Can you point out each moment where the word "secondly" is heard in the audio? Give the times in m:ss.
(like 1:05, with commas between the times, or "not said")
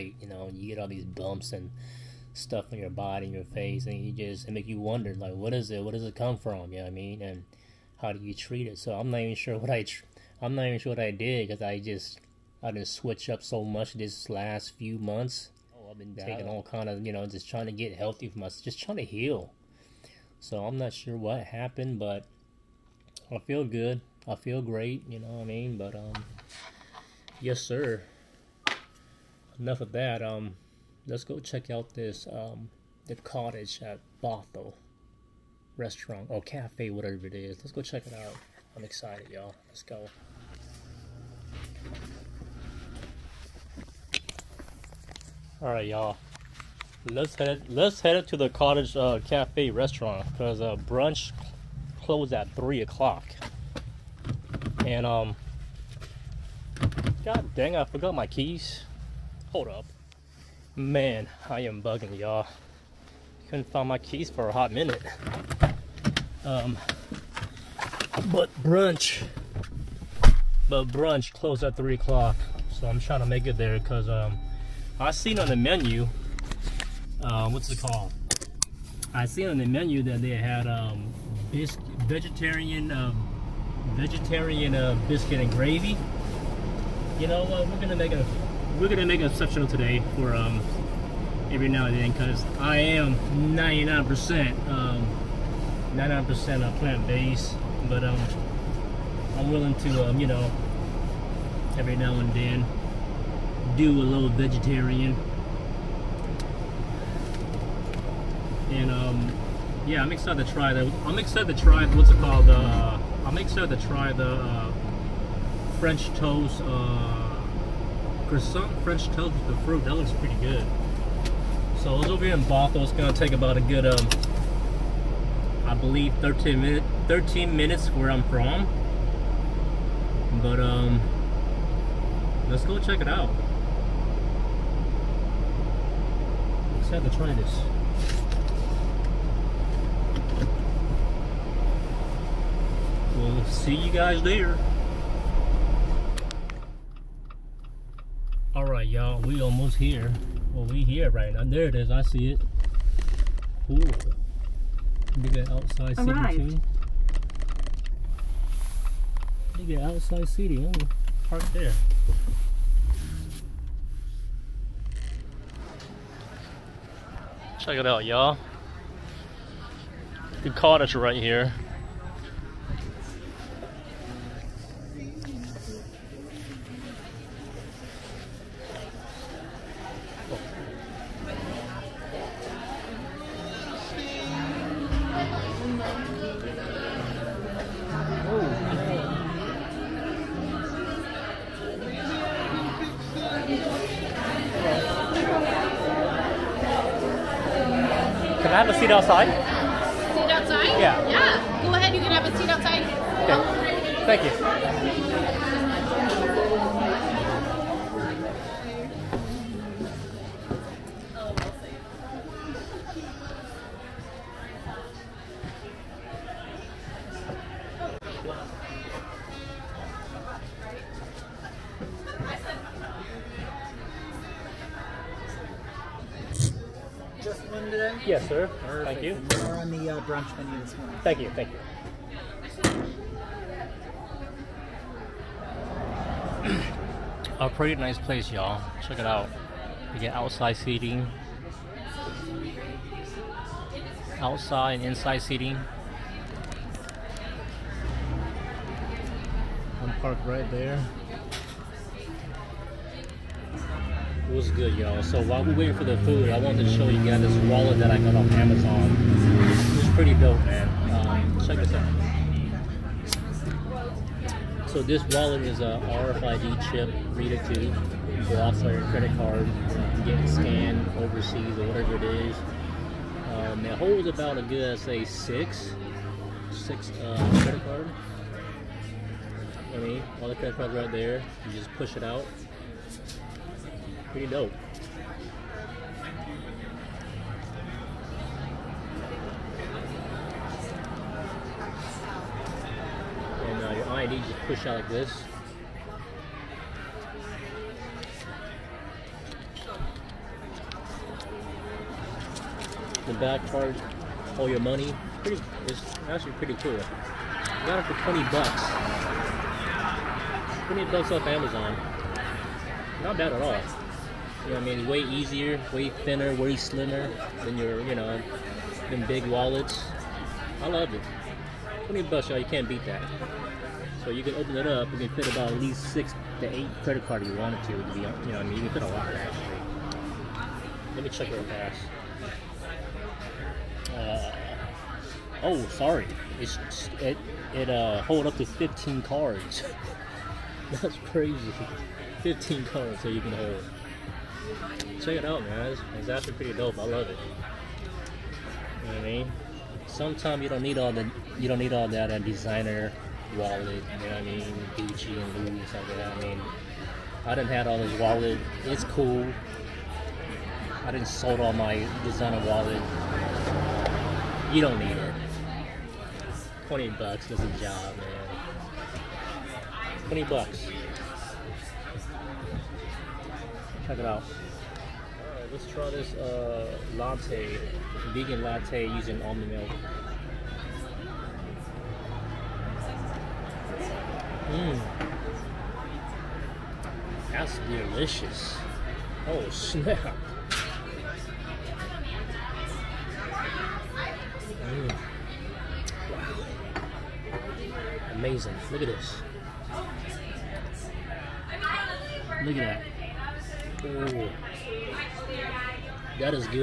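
not said.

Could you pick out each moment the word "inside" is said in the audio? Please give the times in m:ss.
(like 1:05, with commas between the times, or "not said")
4:04.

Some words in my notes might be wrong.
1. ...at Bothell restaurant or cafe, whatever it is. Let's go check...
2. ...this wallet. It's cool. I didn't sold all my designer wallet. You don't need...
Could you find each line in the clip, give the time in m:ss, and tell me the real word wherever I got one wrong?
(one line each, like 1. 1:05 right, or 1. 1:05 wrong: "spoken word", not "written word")
1. 0:33 right
2. 5:57 right.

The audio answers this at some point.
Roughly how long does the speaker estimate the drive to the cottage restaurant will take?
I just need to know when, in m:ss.
2:07.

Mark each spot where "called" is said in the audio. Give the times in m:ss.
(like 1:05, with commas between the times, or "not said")
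1:17, 1:52.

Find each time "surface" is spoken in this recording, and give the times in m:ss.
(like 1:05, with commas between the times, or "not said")
not said.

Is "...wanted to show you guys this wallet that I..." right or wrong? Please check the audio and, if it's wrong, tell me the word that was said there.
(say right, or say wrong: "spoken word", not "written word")
right.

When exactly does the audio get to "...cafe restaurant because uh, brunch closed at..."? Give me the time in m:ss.
0:49.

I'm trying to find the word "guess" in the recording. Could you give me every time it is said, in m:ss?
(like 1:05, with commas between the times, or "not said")
not said.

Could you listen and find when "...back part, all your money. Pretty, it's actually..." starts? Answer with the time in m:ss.
5:03.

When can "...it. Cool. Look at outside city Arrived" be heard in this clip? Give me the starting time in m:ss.
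2:32.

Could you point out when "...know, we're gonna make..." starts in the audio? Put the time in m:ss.
1:27.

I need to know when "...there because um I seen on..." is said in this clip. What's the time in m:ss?
1:13.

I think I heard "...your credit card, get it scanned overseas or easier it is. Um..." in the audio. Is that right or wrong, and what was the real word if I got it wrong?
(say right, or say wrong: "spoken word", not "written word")
wrong: "whatever", not "easier".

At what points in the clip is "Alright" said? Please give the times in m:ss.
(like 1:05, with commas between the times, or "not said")
2:28, 6:15.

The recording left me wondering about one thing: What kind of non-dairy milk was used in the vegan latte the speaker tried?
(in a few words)
Almond milk.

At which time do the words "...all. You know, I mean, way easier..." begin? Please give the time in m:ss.
5:13.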